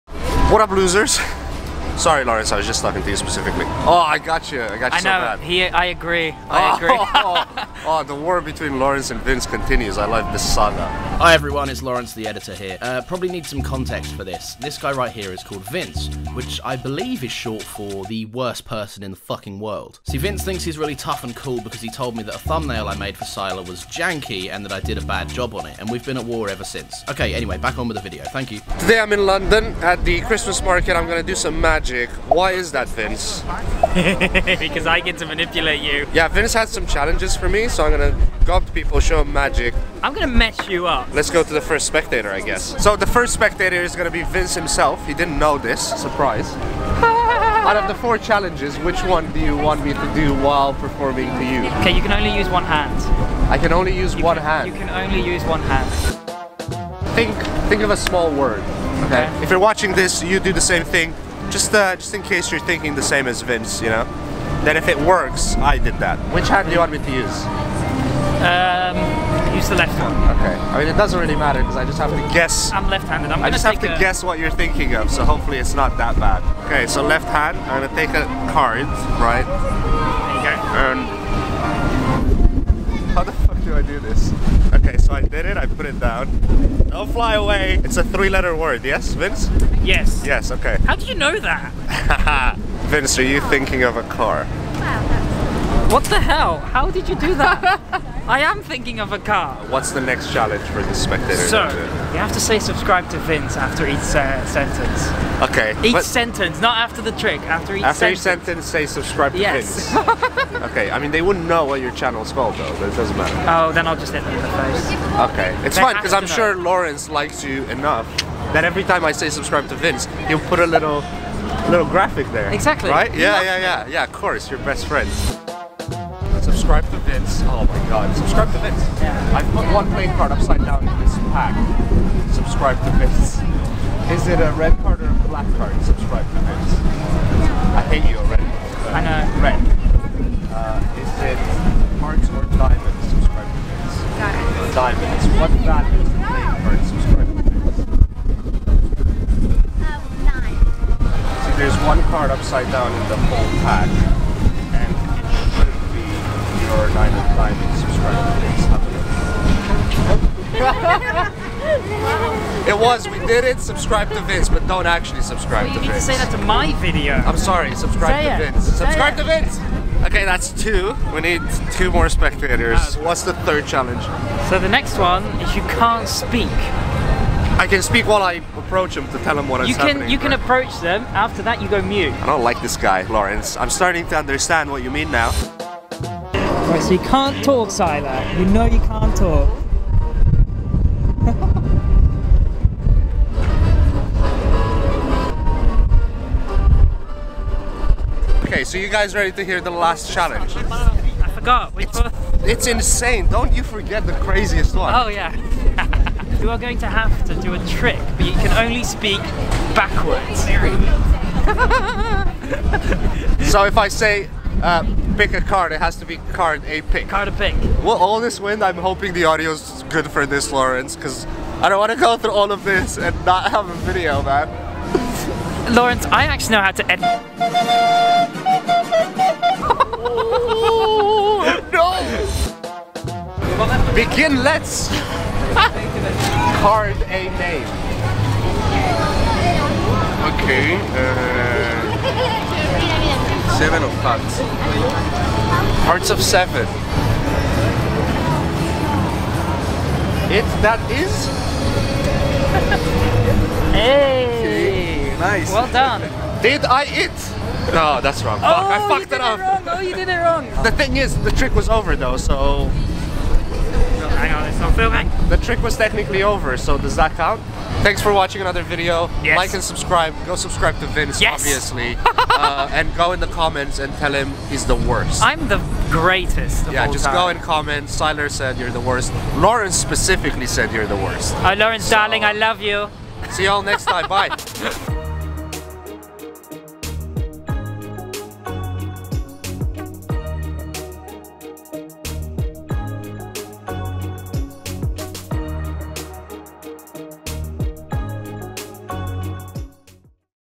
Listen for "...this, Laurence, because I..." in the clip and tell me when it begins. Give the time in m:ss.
3:40.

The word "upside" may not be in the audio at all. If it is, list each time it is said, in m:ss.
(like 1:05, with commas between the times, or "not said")
2:10, 2:32.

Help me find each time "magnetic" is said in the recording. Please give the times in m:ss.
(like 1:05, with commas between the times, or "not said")
not said.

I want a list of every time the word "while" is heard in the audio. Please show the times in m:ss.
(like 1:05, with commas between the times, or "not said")
0:50, 2:58.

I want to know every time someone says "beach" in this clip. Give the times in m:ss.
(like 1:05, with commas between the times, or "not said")
not said.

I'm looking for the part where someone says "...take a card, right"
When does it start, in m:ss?
1:17.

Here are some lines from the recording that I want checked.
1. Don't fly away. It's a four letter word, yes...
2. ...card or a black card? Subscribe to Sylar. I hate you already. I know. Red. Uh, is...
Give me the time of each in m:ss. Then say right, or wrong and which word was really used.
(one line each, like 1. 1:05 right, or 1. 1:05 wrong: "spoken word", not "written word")
1. 1:26 wrong: "three", not "four"
2. 2:14 wrong: "Vince", not "Sylar".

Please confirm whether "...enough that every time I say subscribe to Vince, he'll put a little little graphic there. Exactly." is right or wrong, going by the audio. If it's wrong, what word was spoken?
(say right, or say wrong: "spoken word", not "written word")
right.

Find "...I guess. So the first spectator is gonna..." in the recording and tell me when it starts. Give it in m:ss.
0:42.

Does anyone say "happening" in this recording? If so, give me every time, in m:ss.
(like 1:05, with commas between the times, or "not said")
2:59.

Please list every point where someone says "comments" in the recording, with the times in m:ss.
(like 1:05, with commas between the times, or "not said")
4:33, 4:37.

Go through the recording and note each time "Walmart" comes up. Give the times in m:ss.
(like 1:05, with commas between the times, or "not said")
not said.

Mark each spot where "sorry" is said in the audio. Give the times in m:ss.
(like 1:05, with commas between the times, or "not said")
0:02, 2:47.